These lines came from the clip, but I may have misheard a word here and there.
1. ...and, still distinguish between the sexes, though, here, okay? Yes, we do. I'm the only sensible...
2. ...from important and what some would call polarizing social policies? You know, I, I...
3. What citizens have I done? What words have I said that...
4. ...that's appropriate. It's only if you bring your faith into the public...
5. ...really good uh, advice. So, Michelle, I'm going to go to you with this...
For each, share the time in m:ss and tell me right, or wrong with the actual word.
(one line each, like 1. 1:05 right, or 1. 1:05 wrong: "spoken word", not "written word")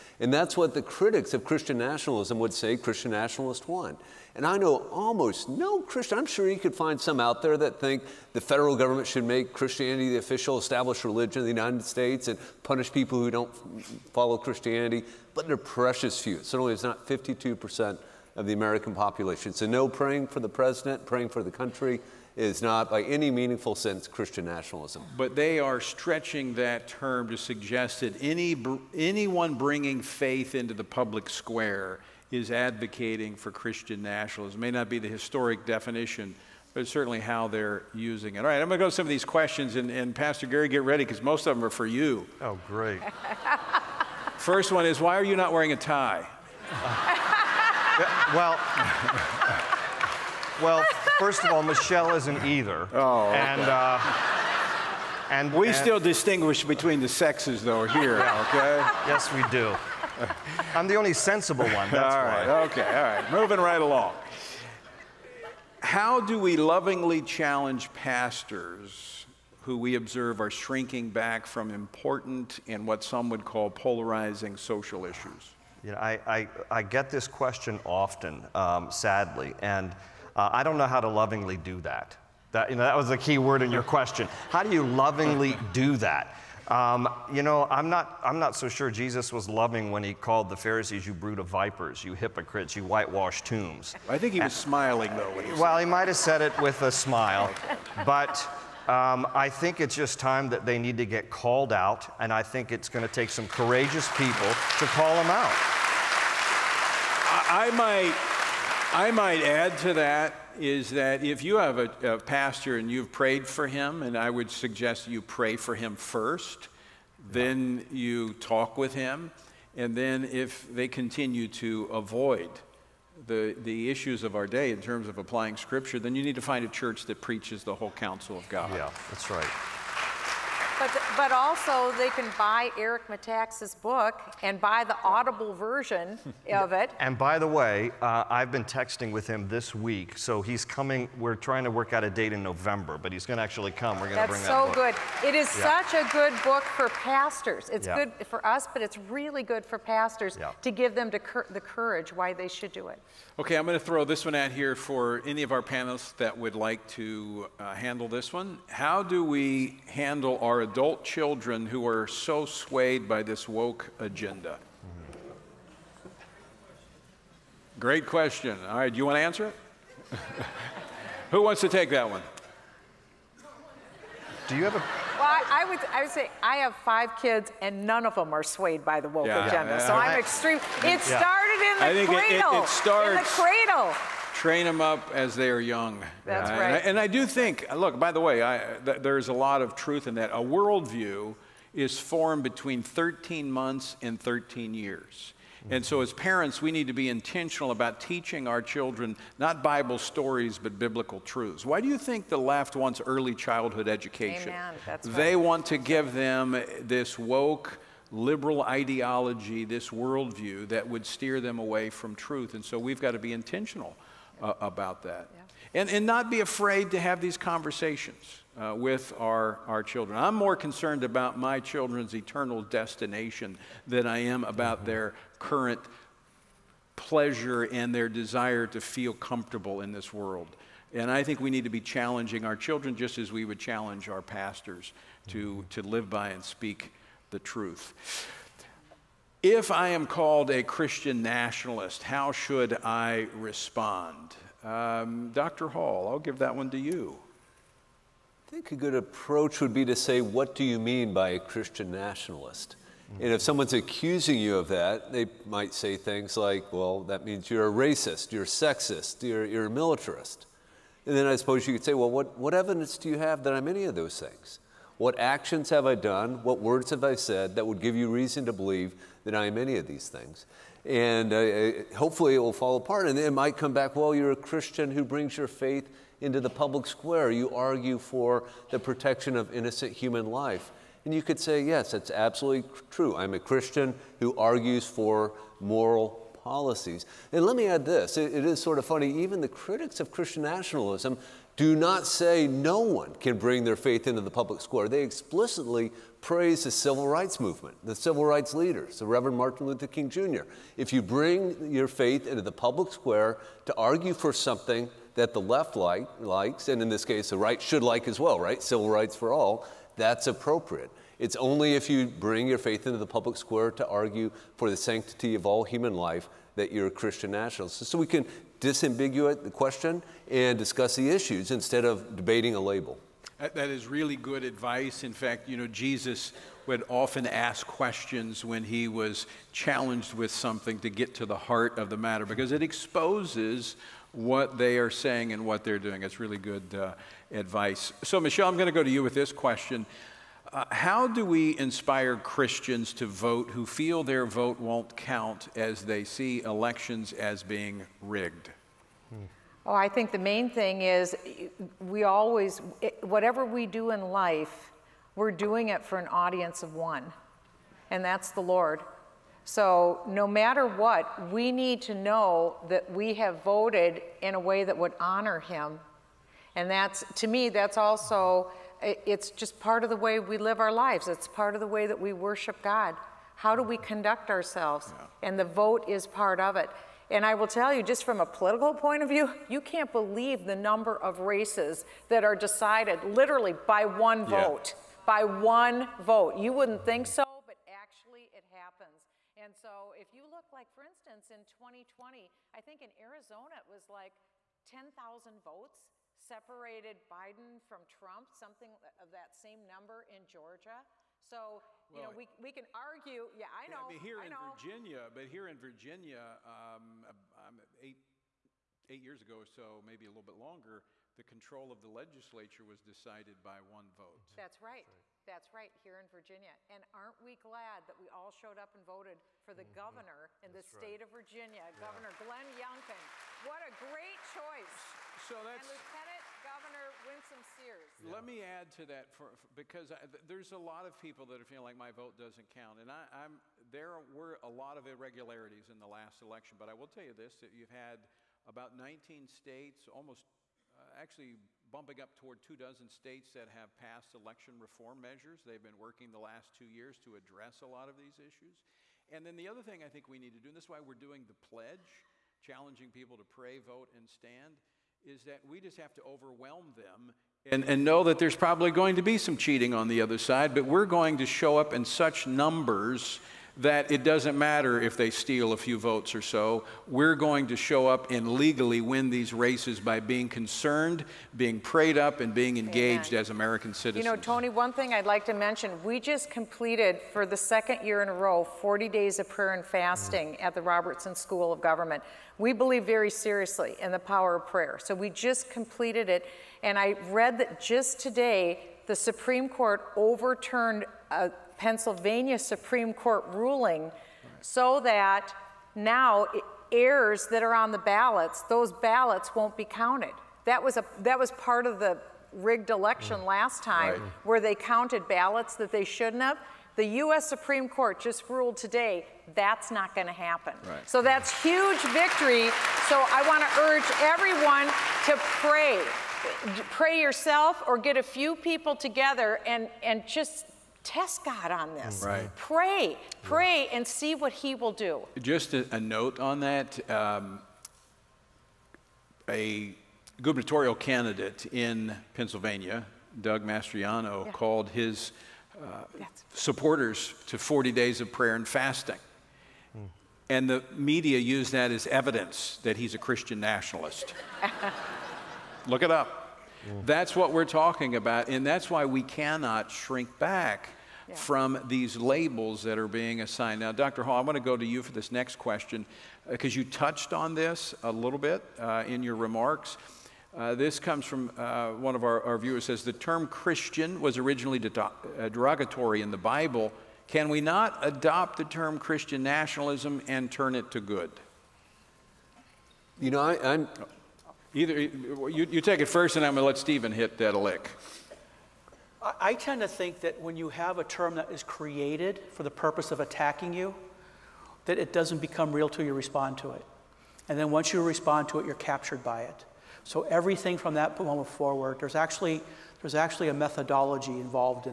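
1. 0:55 right
2. 1:11 wrong: "issues", not "policies"
3. 4:24 wrong: "actions", not "citizens"
4. 5:09 right
5. 5:36 right.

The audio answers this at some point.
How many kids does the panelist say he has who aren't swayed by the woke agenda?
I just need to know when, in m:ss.
2:56.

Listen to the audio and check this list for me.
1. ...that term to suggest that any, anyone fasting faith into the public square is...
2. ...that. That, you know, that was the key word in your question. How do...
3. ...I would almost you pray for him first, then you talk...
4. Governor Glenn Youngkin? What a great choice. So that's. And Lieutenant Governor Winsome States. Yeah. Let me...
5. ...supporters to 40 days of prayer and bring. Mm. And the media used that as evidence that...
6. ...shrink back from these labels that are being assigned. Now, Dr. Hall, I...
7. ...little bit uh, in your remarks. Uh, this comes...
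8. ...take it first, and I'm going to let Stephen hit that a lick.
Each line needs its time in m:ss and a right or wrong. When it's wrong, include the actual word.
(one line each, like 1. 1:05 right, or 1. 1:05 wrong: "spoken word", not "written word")
1. 0:26 wrong: "bringing", not "fasting"
2. 1:21 right
3. 1:54 wrong: "suggest", not "almost"
4. 7:01 wrong: "Sears", not "States"
5. 8:56 wrong: "fasting", not "bring"
6. 9:09 right
7. 9:17 right
8. 9:35 right.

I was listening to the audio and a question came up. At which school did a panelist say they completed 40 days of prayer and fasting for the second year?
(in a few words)
Robertson School of Government.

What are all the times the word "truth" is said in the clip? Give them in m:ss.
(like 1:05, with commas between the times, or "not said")
3:09, 3:21, 3:32, 3:57.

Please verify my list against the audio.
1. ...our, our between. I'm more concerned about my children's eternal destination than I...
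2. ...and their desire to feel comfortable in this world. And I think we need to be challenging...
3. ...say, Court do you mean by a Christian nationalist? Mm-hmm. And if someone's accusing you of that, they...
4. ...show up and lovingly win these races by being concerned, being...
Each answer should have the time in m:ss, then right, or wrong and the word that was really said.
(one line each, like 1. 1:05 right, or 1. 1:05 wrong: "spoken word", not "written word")
1. 3:39 wrong: "children", not "between"
2. 3:47 right
3. 4:09 wrong: "What", not "Court"
4. 7:47 wrong: "legally", not "lovingly".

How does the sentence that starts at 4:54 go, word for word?
They explicitly praise the civil rights movement, the civil rights leaders, the Reverend Martin Luther King Jr.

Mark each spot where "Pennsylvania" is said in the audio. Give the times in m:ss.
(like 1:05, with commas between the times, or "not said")
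8:11, 8:52.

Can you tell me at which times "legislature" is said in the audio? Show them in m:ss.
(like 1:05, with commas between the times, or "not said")
6:51.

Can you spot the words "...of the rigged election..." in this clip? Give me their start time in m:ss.
8:21.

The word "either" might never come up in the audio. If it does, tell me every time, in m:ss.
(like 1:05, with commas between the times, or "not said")
0:52, 9:34.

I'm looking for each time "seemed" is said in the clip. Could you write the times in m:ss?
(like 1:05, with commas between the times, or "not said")
not said.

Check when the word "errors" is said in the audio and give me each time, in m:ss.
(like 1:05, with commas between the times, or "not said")
8:16.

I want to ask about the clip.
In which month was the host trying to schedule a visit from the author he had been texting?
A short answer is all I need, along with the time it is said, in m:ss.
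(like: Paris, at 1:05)
November, at 2:22.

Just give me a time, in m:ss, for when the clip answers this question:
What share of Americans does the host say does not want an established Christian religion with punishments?
0:17.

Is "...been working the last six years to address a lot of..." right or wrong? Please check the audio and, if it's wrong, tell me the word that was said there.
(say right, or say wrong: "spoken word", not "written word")
wrong: "two", not "six".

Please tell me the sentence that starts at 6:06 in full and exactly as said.
And that's, to me, that's also it's just part of the way we live our lives.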